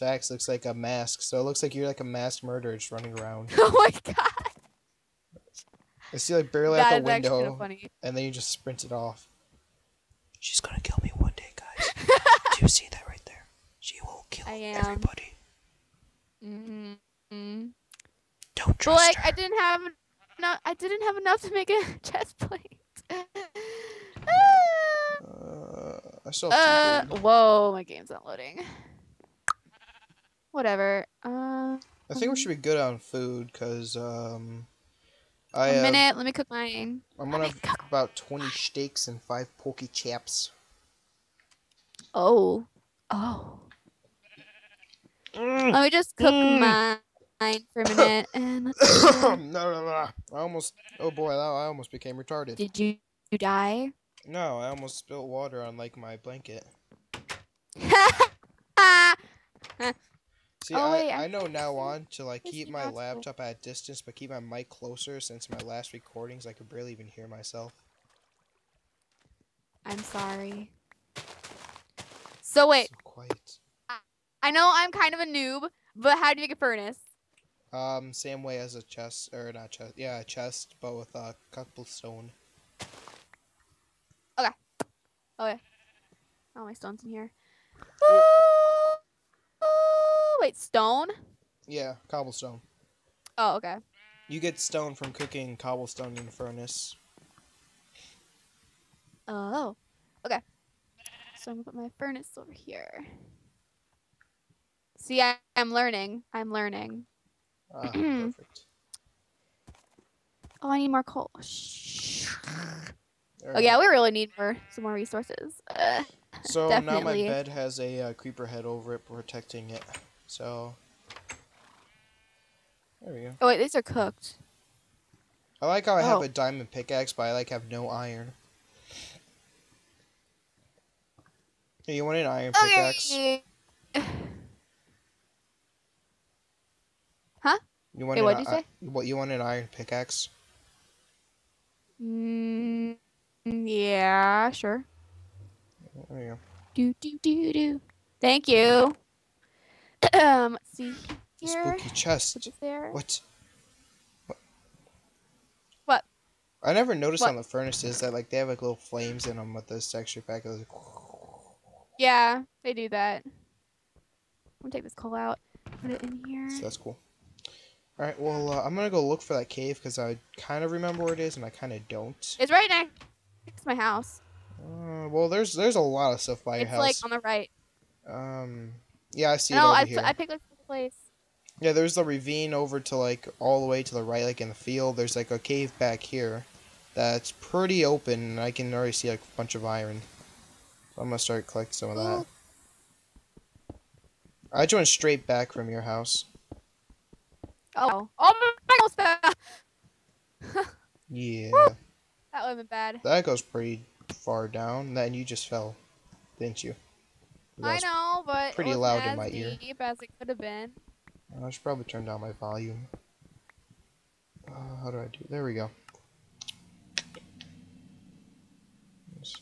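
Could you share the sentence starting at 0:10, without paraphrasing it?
She's gonna kill me one day, guys.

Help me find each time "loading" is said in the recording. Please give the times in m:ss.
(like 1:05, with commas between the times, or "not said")
0:28.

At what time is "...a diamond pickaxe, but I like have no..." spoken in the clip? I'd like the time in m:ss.
2:06.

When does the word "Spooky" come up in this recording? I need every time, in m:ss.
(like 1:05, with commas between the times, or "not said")
2:31.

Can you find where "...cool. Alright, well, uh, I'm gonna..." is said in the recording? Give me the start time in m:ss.
2:46.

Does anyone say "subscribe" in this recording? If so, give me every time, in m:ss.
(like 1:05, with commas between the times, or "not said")
not said.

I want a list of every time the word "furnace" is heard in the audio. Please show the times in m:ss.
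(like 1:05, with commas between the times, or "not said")
1:16, 1:36, 1:41, 2:37.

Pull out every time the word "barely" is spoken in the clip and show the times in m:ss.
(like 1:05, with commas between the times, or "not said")
0:06, 1:06.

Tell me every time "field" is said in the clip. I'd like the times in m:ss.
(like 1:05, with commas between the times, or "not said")
3:04.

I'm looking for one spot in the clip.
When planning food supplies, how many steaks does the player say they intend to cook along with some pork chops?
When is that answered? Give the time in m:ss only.
0:38.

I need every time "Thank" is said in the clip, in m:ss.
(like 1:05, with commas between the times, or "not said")
2:28.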